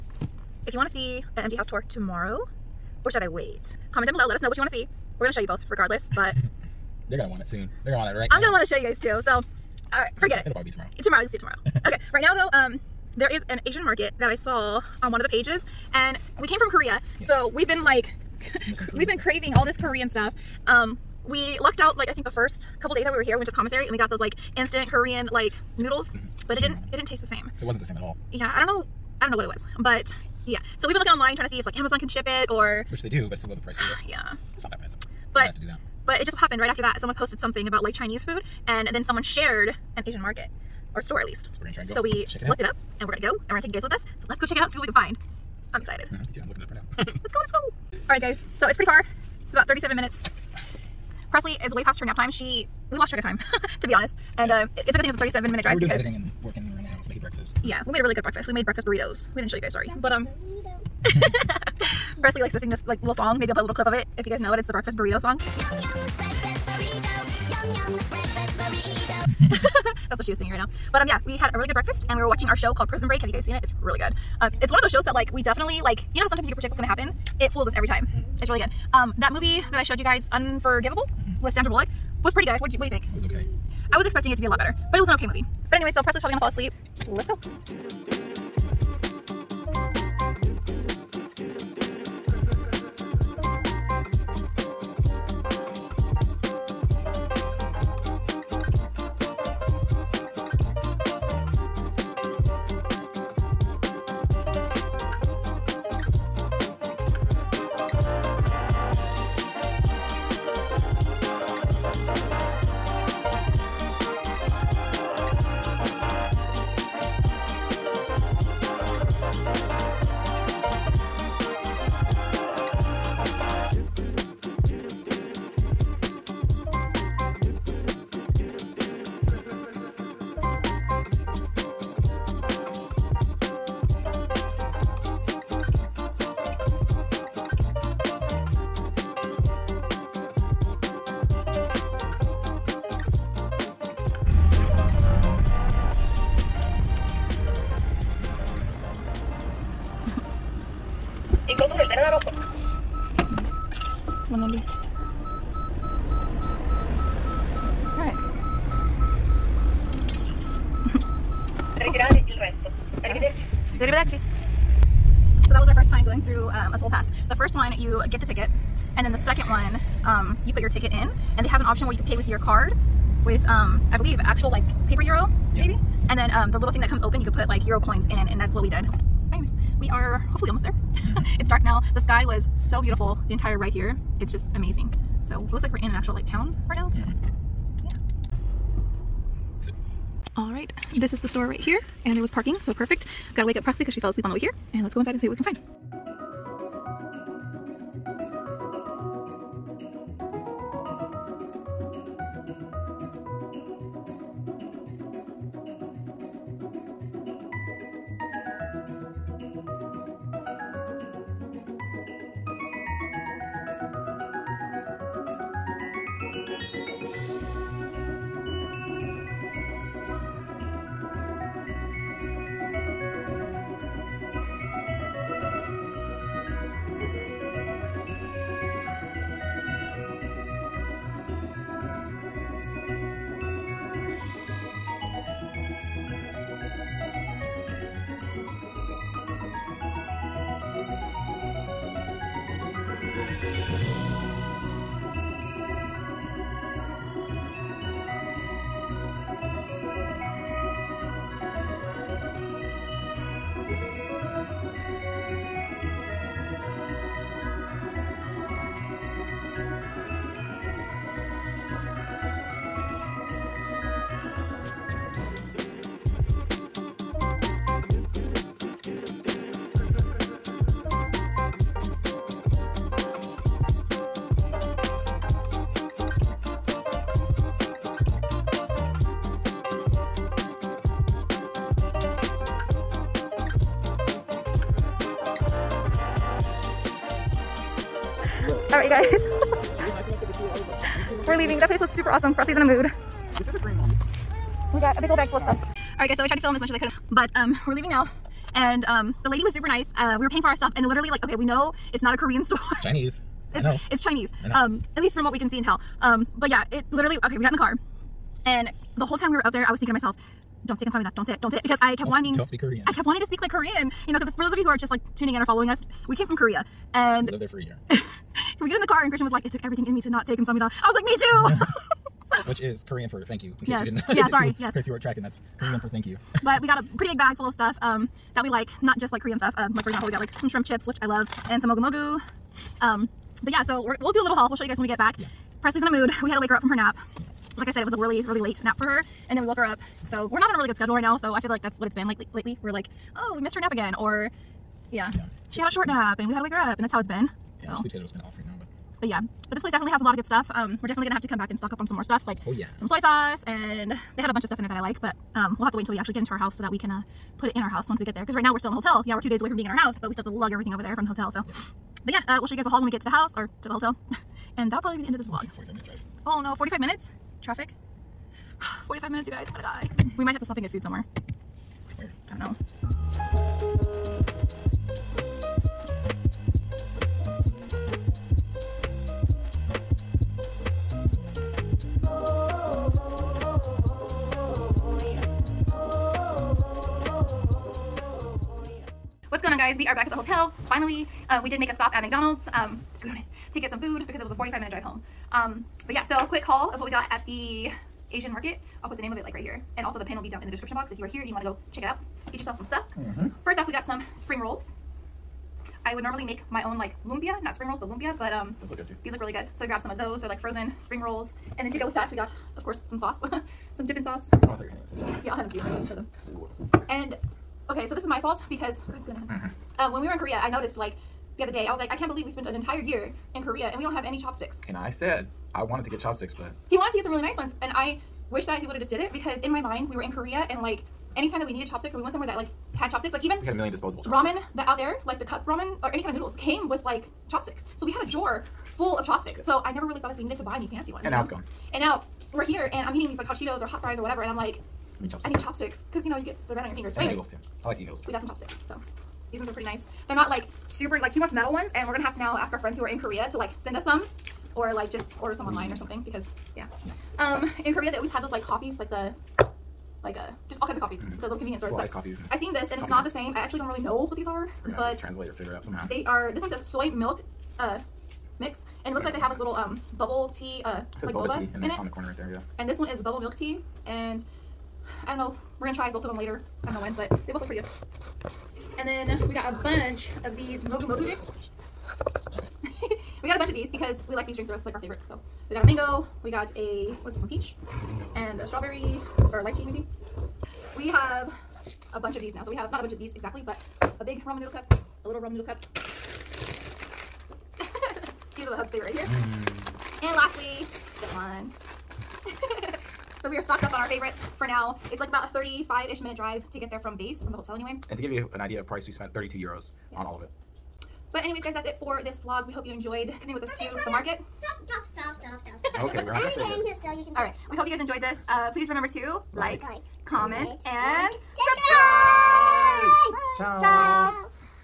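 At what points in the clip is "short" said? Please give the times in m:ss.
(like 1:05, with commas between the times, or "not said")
5:45.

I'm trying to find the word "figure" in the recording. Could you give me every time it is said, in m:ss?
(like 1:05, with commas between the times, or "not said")
7:45.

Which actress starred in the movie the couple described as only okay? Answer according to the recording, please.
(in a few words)
Sandra Bullock.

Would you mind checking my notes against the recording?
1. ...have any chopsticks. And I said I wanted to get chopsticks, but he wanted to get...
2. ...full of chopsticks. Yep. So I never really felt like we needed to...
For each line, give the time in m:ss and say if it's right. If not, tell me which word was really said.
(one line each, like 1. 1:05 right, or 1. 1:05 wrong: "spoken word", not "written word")
1. 7:03 right
2. 7:18 right.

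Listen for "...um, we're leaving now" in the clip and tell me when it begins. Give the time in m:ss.
4:57.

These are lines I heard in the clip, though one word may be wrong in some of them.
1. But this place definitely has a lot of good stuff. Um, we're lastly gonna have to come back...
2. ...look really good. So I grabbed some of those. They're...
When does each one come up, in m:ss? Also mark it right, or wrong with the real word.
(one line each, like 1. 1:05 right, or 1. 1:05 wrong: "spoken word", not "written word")
1. 5:49 wrong: "definitely", not "lastly"
2. 6:49 right.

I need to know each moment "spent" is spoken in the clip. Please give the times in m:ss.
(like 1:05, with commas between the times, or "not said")
7:02, 8:28.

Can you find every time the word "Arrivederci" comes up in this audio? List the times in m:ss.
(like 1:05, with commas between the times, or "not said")
2:43.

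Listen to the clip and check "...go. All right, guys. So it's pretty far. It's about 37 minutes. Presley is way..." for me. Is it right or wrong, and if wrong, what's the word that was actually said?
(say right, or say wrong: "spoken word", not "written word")
right.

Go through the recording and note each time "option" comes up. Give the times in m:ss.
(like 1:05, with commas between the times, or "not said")
2:51.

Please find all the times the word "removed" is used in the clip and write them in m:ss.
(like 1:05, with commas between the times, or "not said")
not said.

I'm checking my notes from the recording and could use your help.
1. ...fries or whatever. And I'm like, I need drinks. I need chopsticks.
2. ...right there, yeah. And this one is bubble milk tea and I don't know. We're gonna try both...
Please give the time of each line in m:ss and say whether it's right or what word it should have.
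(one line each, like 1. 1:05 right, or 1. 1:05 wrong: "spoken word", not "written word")
1. 7:23 wrong: "chopsticks", not "drinks"
2. 7:52 right.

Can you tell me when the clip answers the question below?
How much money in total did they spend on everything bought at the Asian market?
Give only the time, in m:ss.
8:29.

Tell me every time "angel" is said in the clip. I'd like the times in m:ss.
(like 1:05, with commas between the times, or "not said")
not said.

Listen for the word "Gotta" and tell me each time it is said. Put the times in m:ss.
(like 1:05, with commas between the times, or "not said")
3:13.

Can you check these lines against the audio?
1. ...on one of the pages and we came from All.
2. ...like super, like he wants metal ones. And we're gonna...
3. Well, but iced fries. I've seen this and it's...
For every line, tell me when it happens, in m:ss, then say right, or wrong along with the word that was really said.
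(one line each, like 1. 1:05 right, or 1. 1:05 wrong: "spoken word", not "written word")
1. 0:15 wrong: "Korea", not "All"
2. 7:30 right
3. 7:41 wrong: "coffees", not "fries".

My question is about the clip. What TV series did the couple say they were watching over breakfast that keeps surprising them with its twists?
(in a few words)
Prison Break.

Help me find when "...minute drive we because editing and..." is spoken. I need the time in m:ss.
0:55.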